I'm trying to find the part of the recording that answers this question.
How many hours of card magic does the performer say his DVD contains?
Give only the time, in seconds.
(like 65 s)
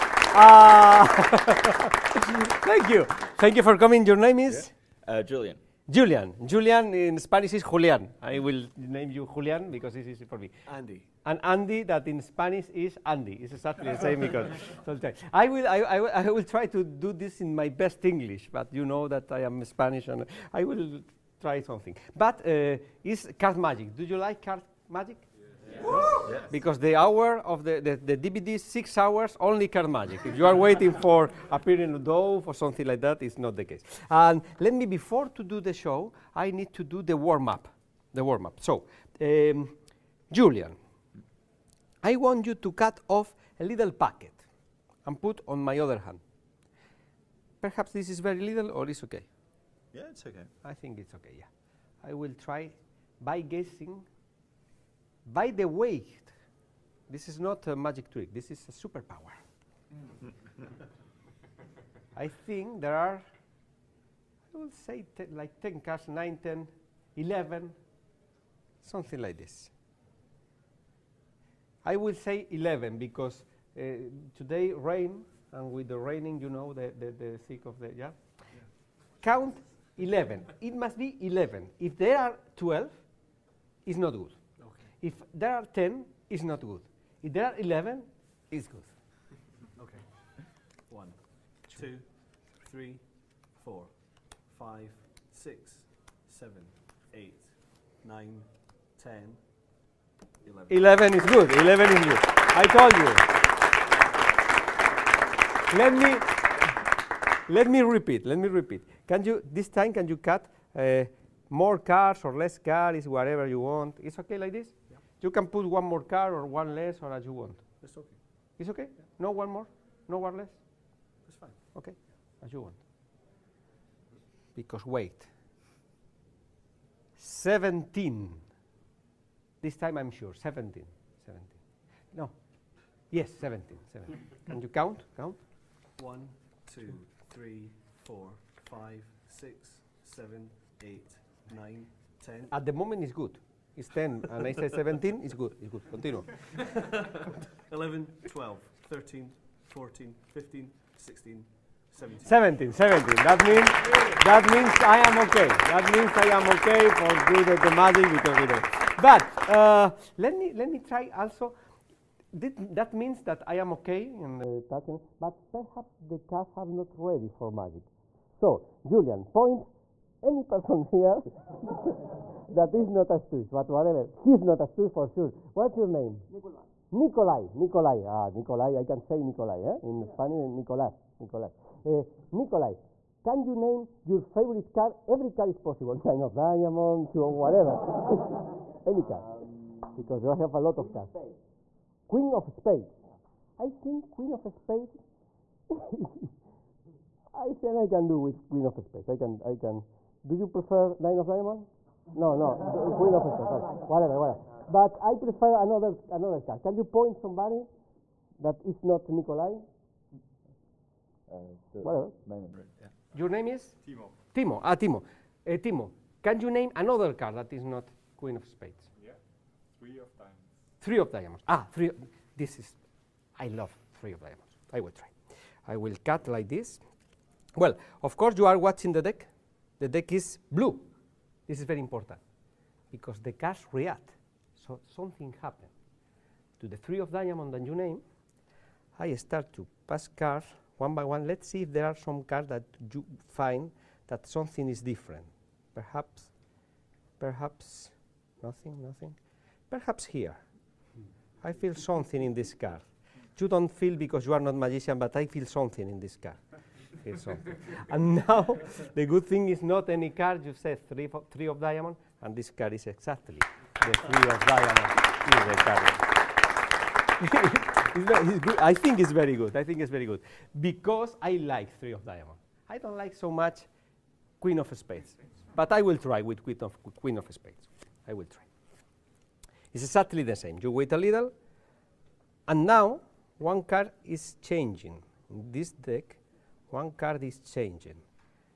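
28 s.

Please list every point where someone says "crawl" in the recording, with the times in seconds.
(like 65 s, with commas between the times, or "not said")
not said.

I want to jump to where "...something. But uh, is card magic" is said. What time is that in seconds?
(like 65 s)
21 s.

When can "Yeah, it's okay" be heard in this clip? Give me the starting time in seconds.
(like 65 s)
49 s.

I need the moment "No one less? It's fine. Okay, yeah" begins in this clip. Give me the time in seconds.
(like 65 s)
120 s.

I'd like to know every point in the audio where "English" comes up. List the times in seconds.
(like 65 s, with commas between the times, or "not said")
18 s.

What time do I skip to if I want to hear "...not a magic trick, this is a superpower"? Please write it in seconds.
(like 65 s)
57 s.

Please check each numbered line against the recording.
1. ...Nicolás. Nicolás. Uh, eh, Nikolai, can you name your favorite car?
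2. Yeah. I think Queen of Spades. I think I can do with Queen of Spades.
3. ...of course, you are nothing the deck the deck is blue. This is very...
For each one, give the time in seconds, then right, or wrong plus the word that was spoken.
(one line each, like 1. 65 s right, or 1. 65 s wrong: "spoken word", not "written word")
1. 180 s right
2. 193 s right
3. 228 s wrong: "watching", not "nothing".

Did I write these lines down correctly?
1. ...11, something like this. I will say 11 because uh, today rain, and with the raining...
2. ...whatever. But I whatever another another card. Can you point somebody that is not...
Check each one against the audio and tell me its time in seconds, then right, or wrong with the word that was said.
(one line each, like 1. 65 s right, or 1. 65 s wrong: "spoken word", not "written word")
1. 67 s right
2. 204 s wrong: "prefer", not "whatever".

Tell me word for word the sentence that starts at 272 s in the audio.
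I don't like so much queen of spades, but I will try with queen of queen of spades.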